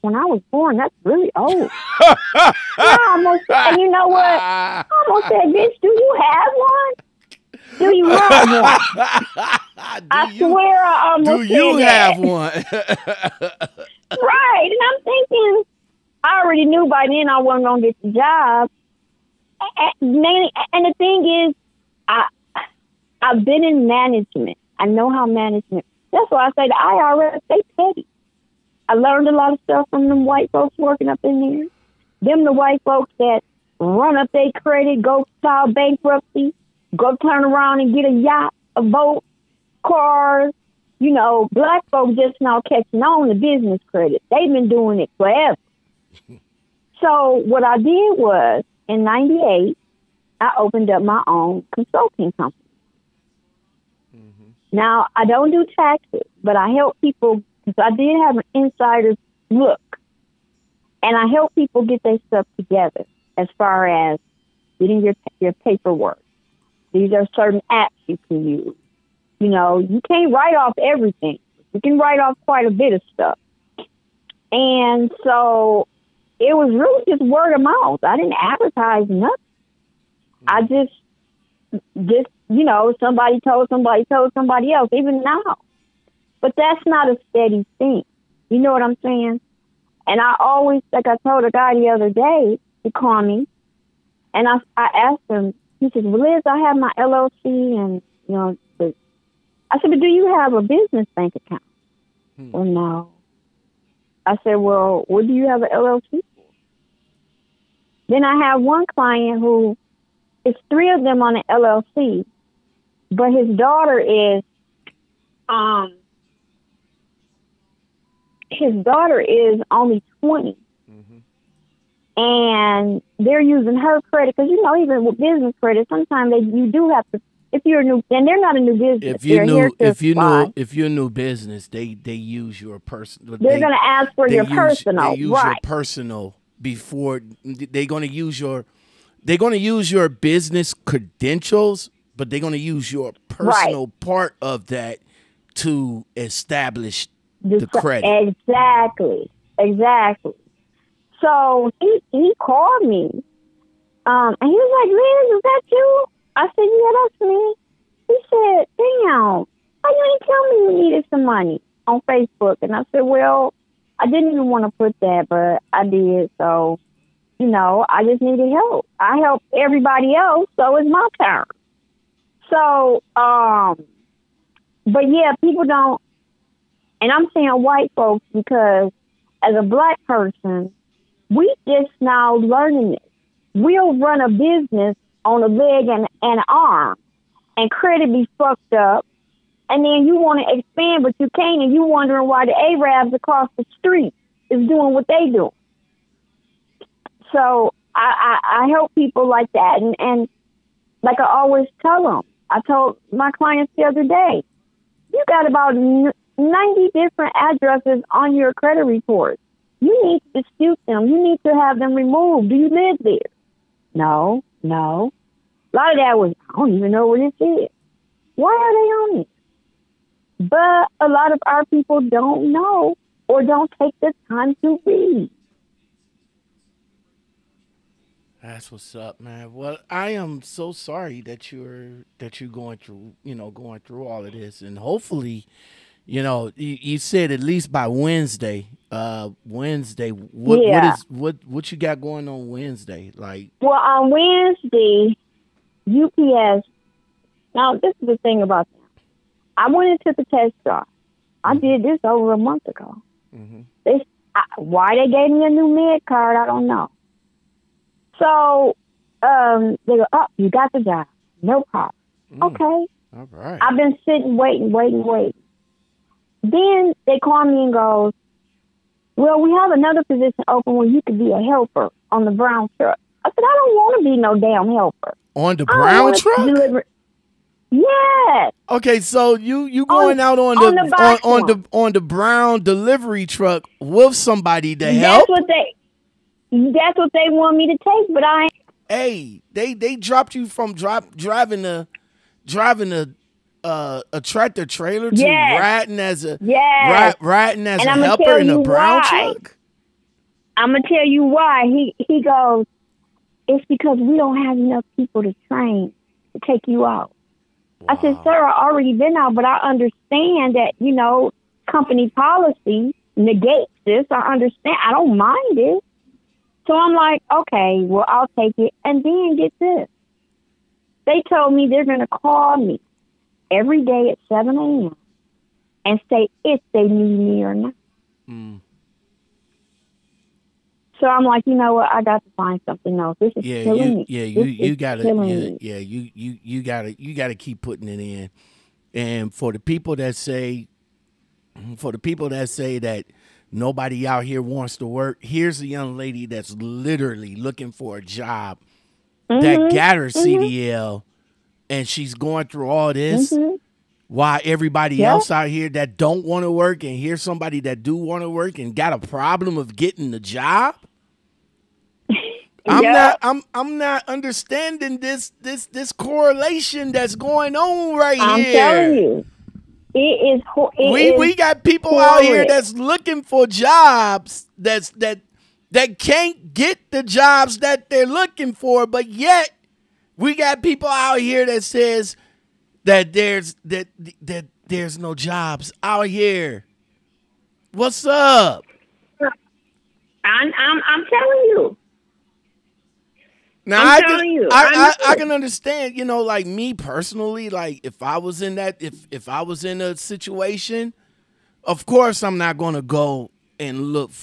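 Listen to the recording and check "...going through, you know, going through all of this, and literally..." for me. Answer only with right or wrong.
wrong.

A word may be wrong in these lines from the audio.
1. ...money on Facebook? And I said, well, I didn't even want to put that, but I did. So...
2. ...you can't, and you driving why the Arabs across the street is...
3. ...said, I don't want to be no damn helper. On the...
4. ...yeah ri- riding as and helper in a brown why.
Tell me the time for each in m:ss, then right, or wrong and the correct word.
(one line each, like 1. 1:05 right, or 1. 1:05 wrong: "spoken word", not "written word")
1. 2:41 right
2. 3:11 wrong: "wondering", not "driving"
3. 4:33 right
4. 4:56 right.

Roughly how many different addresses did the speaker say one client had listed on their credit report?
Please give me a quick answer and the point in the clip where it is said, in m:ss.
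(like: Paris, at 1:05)
90, at 3:25.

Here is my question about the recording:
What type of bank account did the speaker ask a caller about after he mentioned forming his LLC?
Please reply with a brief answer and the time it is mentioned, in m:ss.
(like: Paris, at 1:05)
business bank account, at 1:40.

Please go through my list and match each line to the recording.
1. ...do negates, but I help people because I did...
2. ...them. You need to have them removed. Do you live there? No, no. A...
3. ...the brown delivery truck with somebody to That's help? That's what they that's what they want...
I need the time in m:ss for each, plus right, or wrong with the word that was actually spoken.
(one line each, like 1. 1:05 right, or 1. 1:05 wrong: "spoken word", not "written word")
1. 0:55 wrong: "taxes", not "negates"
2. 3:30 right
3. 4:41 right.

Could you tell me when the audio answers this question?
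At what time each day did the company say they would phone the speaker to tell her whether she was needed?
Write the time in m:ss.
5:24.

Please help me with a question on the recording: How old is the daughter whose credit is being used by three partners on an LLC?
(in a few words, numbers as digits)
20.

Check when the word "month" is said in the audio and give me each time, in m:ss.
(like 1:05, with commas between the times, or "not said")
4:12.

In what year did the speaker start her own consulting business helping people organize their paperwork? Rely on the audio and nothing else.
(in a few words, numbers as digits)
1998.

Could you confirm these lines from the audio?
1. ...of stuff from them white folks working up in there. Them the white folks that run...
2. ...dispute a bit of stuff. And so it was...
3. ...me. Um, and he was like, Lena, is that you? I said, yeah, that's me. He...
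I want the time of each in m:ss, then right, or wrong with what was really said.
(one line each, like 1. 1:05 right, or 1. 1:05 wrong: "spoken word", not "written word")
1. 0:29 right
2. 1:12 wrong: "quite", not "dispute"
3. 2:32 right.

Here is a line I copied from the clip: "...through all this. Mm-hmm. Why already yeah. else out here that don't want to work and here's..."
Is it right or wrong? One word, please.
wrong.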